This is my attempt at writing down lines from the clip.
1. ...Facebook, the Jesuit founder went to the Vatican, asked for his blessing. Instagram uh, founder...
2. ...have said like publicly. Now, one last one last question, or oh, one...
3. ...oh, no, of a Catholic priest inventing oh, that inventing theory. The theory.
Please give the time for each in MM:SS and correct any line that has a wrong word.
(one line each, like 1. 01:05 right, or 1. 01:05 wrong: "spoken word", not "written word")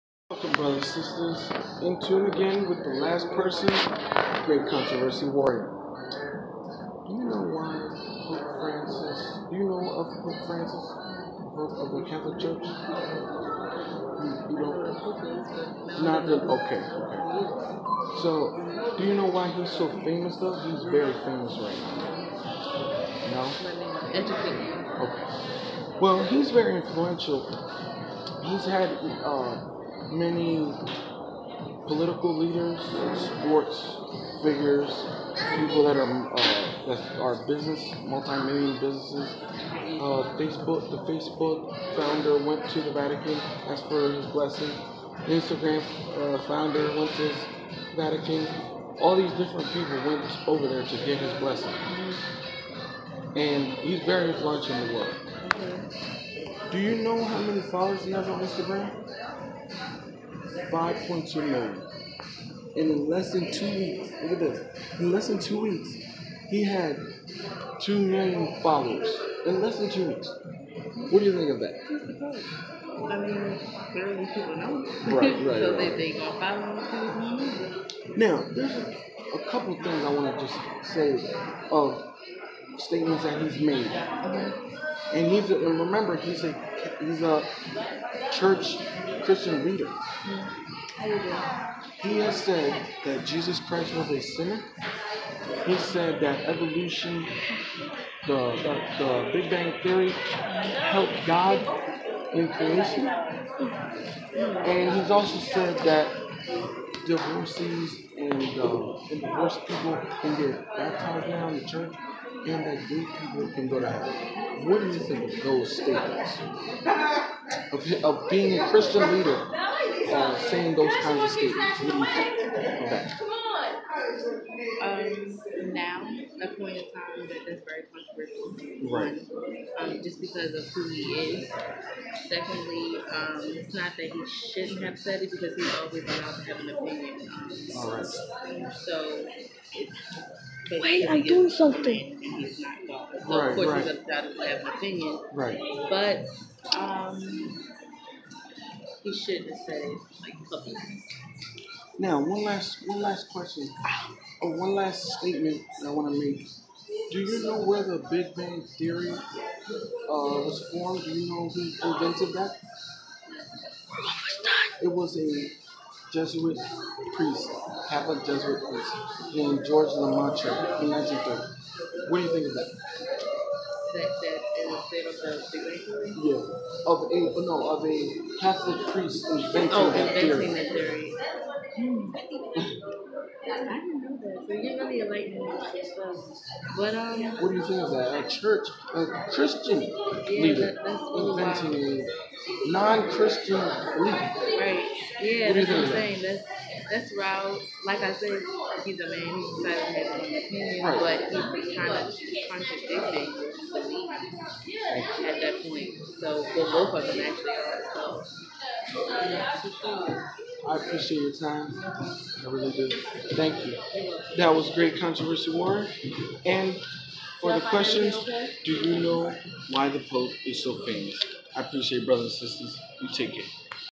1. 00:40 wrong: "Facebook", not "Jesuit"
2. 02:29 right
3. 02:57 right.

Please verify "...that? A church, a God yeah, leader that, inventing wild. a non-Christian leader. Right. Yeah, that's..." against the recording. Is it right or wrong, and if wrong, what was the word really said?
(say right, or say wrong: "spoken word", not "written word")
wrong: "Christian", not "God".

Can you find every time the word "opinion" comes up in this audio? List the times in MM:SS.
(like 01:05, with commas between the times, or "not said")
02:16, 02:24, 03:20.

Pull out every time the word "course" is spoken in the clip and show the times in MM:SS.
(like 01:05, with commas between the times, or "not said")
02:23.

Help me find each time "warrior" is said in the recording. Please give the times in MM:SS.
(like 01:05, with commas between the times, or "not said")
00:05, 03:35.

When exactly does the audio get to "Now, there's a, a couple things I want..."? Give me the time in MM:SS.
01:18.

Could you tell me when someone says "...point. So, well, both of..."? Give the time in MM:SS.
03:25.